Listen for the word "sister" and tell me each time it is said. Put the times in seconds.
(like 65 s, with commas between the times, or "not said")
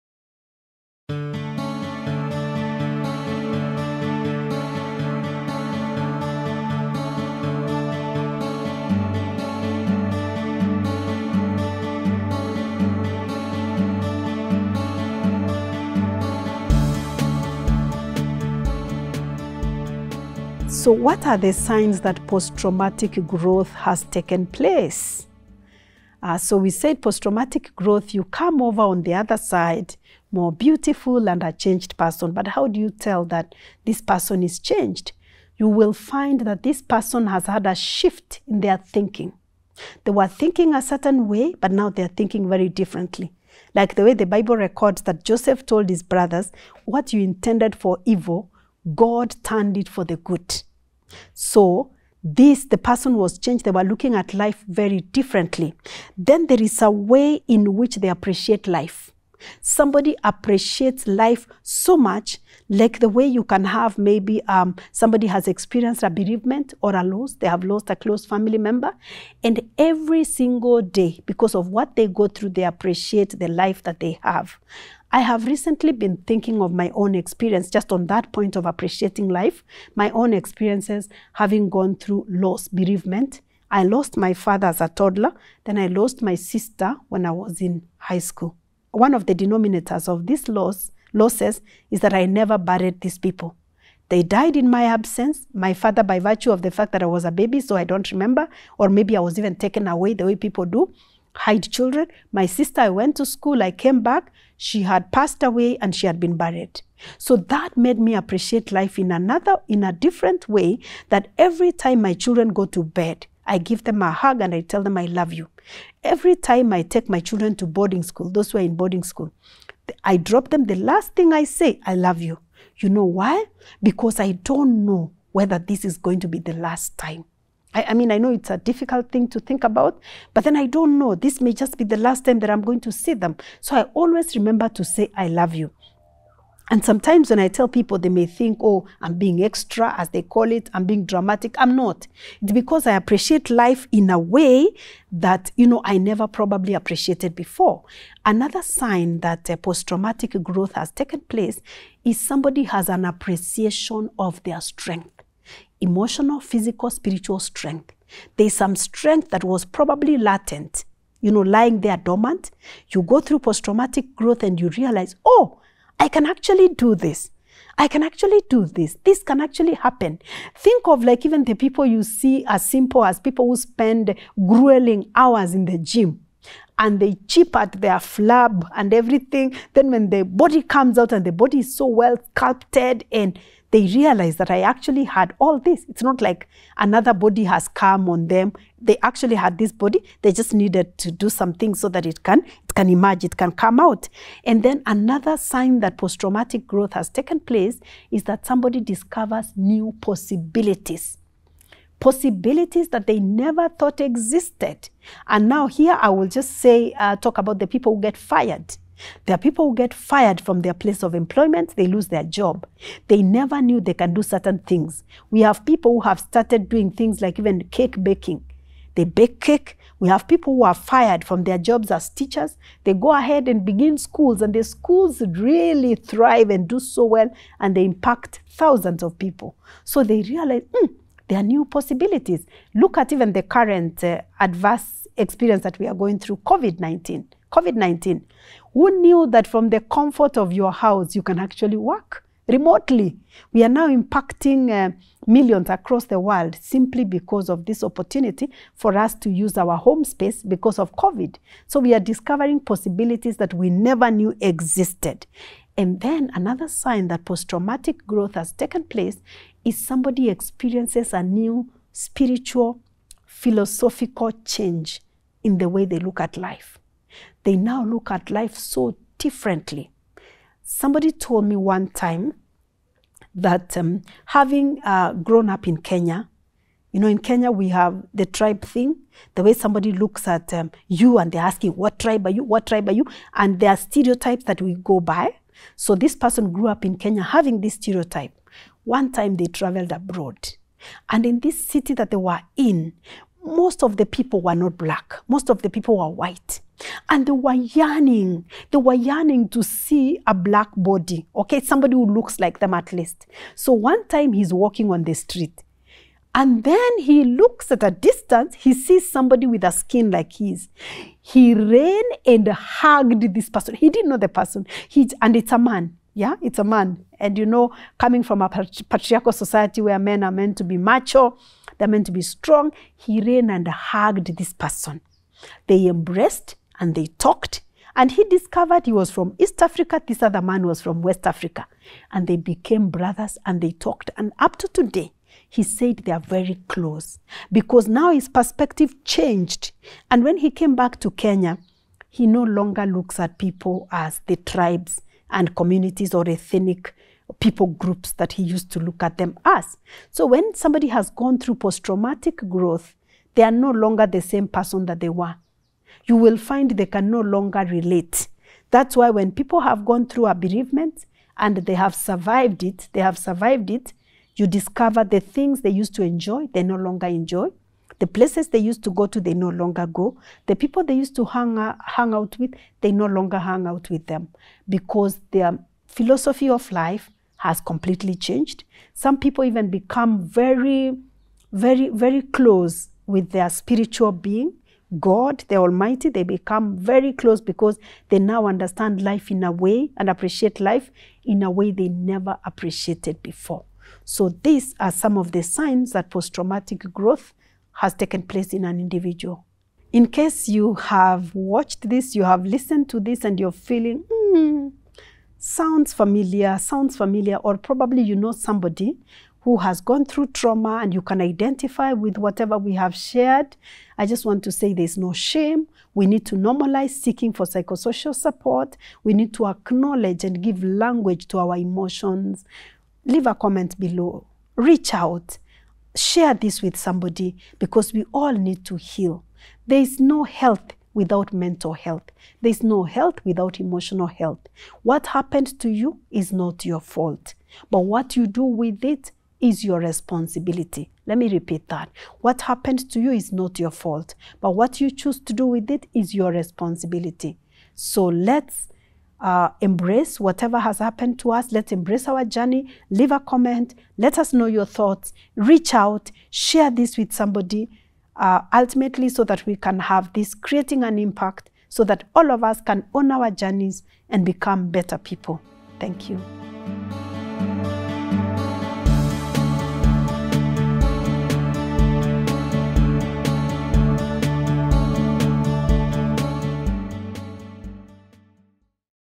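86 s, 102 s.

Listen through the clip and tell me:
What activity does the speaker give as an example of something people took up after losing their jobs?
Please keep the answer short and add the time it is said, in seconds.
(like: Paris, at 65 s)
Cake baking, at 217 s.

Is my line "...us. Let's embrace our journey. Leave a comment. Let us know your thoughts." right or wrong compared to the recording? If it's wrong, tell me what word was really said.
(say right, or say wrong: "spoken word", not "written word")
right.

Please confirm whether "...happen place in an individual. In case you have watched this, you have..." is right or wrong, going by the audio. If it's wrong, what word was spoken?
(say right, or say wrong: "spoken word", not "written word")
wrong: "taken", not "happen".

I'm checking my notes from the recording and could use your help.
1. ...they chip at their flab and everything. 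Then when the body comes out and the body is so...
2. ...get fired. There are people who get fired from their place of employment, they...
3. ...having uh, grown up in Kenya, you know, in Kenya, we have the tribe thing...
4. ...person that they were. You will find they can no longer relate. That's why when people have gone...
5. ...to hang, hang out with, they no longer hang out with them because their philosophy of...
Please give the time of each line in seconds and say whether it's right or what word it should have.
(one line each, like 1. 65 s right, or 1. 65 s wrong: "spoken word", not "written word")
1. 176 s right
2. 208 s right
3. 274 s right
4. 354 s right
5. 371 s right.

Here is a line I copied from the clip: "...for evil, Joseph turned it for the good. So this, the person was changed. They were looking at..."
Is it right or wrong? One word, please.
wrong.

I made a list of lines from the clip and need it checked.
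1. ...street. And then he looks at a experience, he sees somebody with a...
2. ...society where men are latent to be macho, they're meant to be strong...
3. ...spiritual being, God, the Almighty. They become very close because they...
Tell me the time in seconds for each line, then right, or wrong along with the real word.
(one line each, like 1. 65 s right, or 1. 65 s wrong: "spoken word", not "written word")
1. 305 s wrong: "distance", not "experience"
2. 319 s wrong: "meant", not "latent"
3. 383 s right.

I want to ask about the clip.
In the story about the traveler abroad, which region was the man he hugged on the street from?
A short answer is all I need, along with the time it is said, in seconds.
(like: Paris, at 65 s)
West Africa, at 331 s.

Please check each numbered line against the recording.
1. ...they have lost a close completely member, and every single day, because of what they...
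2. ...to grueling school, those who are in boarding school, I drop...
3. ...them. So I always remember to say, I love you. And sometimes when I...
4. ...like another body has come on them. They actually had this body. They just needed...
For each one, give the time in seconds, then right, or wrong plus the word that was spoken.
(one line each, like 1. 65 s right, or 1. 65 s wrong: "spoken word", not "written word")
1. 67 s wrong: "family", not "completely"
2. 117 s wrong: "boarding", not "grueling"
3. 133 s right
4. 186 s right.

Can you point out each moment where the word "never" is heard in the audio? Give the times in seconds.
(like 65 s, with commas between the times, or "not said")
92 s, 145 s, 203 s, 213 s, 253 s, 391 s.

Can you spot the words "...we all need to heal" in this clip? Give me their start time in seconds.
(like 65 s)
427 s.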